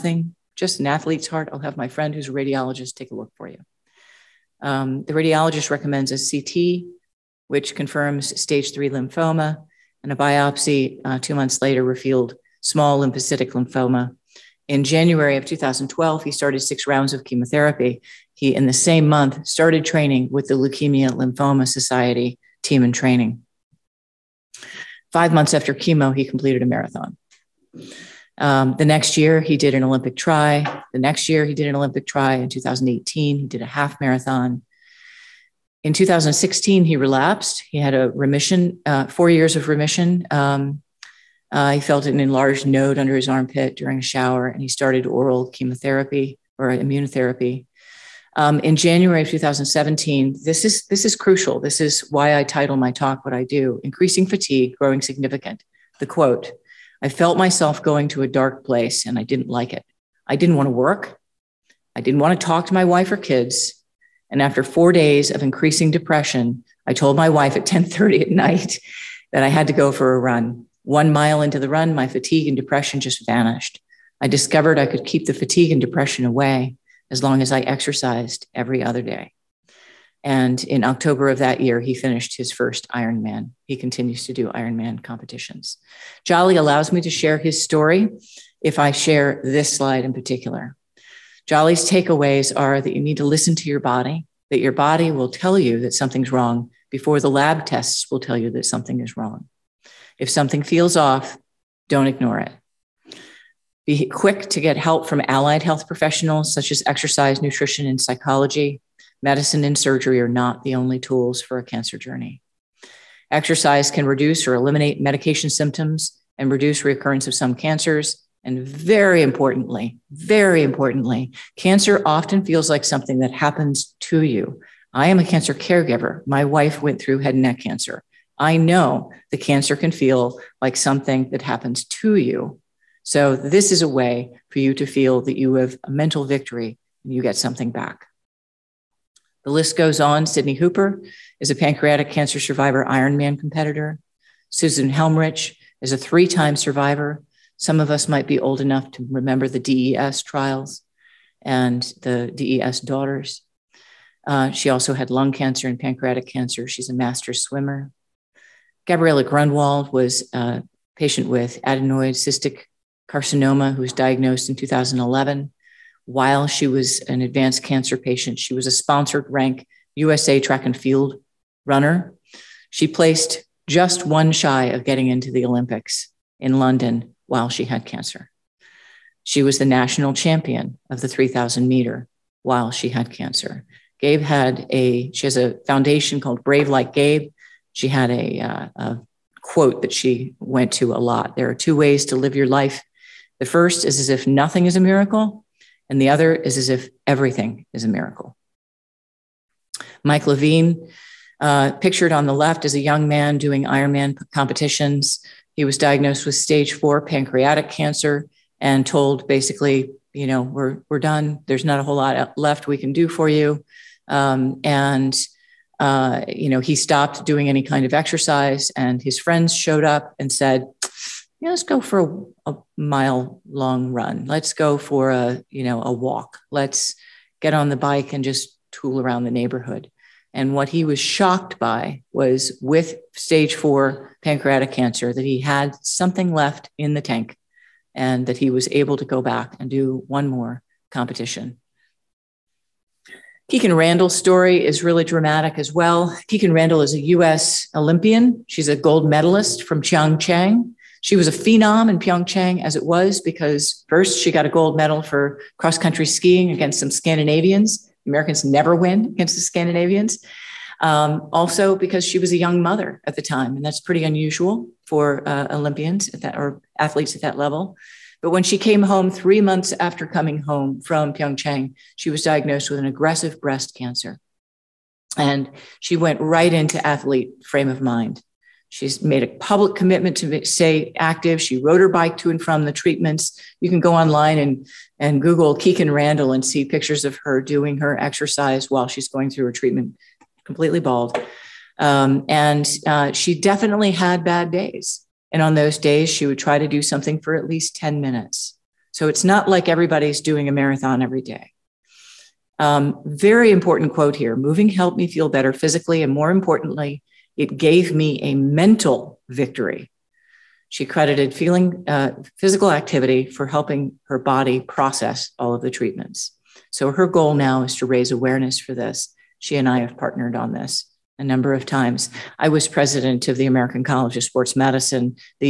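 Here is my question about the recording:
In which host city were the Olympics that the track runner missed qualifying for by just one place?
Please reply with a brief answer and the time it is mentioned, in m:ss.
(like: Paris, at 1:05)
London, at 2:56.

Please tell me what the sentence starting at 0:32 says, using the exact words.
In 2018, he did a half marathon in 2016, he relapsed.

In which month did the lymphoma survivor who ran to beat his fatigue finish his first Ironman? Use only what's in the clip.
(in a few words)
October.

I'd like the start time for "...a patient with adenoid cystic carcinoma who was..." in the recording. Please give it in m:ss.
2:40.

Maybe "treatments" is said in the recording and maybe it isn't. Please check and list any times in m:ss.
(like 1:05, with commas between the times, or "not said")
4:42, 4:49, 5:15.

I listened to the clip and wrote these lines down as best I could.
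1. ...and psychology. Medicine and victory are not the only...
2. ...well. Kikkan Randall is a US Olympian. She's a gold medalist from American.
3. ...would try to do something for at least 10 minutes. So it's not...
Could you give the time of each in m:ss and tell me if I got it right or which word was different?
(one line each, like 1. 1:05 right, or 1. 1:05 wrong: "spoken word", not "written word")
1. 1:47 wrong: "surgery", not "victory"
2. 4:05 wrong: "Pyeongchang", not "American"
3. 4:56 right.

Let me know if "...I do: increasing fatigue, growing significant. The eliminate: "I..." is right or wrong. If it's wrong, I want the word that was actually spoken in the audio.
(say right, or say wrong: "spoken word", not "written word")
wrong: "quote", not "eliminate".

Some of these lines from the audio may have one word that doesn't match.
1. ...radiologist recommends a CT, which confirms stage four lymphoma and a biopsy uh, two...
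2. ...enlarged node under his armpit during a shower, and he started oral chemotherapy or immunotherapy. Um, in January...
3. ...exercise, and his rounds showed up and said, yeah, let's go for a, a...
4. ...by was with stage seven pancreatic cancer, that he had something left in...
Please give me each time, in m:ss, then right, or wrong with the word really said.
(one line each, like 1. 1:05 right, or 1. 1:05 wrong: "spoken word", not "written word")
1. 0:05 wrong: "three", not "four"
2. 0:42 right
3. 3:37 wrong: "friends", not "rounds"
4. 3:51 wrong: "four", not "seven".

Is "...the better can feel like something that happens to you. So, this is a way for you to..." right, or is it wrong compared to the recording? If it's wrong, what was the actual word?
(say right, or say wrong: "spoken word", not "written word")
wrong: "cancer", not "better".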